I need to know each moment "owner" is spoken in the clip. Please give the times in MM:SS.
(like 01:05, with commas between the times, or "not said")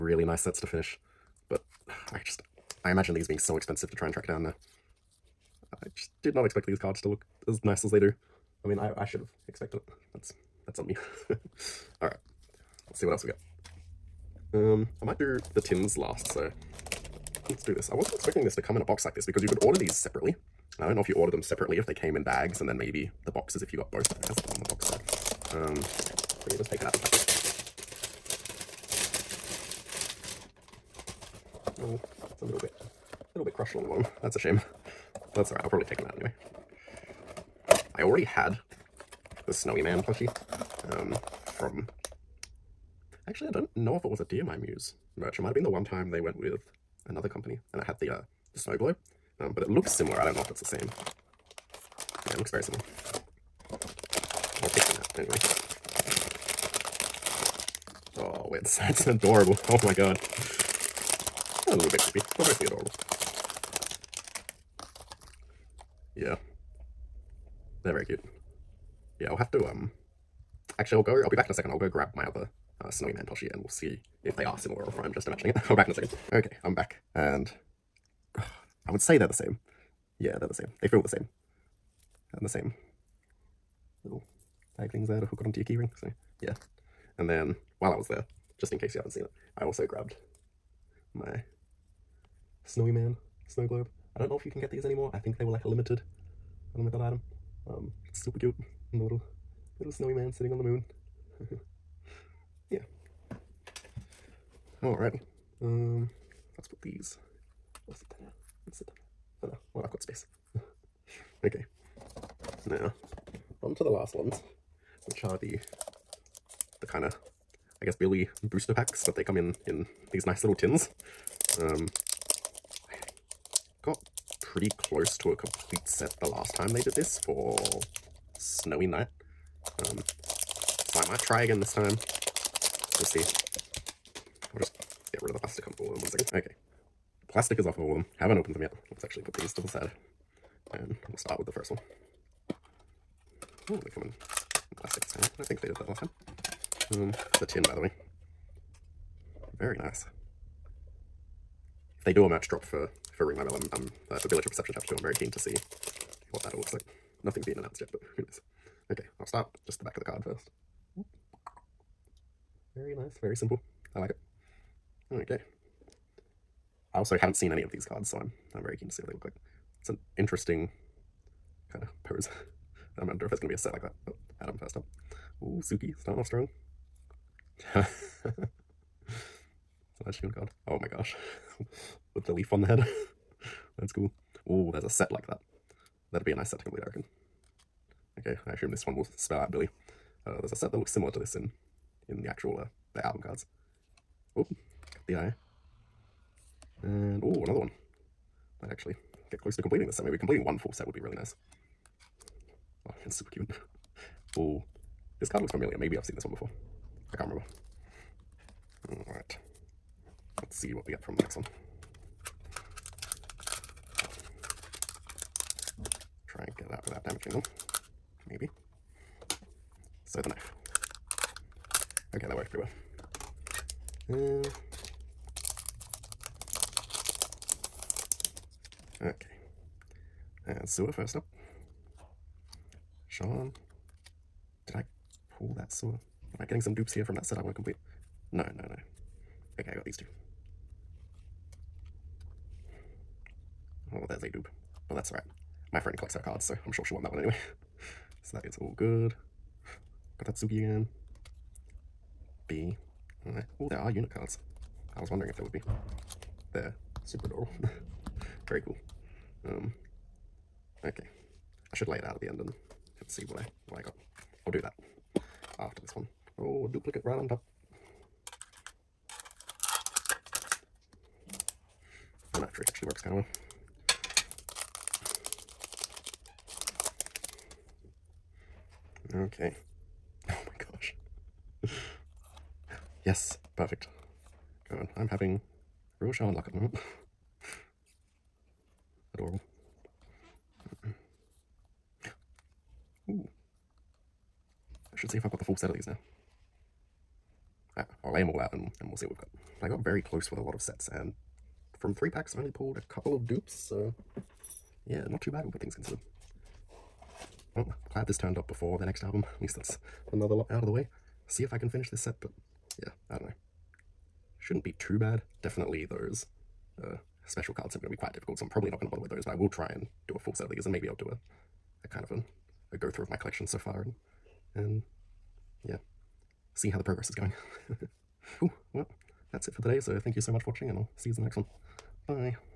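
not said.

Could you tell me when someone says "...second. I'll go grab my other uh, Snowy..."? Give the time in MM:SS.
01:11.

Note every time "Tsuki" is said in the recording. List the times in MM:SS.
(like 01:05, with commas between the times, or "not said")
02:55, 04:10.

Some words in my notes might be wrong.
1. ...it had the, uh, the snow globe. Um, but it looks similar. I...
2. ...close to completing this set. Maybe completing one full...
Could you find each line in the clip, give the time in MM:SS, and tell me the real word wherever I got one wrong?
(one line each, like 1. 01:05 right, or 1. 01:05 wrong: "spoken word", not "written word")
1. 00:47 right
2. 03:19 right.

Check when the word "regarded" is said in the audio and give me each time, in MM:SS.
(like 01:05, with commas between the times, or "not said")
not said.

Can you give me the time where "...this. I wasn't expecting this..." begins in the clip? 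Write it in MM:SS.
00:17.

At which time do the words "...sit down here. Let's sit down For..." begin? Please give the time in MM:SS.
01:47.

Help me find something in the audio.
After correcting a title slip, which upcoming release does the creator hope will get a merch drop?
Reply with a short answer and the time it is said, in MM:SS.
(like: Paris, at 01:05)
Village of Perception Chapter 2, at 02:34.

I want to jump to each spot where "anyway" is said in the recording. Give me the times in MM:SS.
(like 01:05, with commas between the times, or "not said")
00:36, 00:55, 04:07.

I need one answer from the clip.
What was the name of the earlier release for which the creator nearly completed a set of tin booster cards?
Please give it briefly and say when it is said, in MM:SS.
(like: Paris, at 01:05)
Snowy Night, at 02:08.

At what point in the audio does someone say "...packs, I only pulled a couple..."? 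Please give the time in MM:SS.
05:02.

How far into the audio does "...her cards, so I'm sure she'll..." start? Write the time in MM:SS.
04:06.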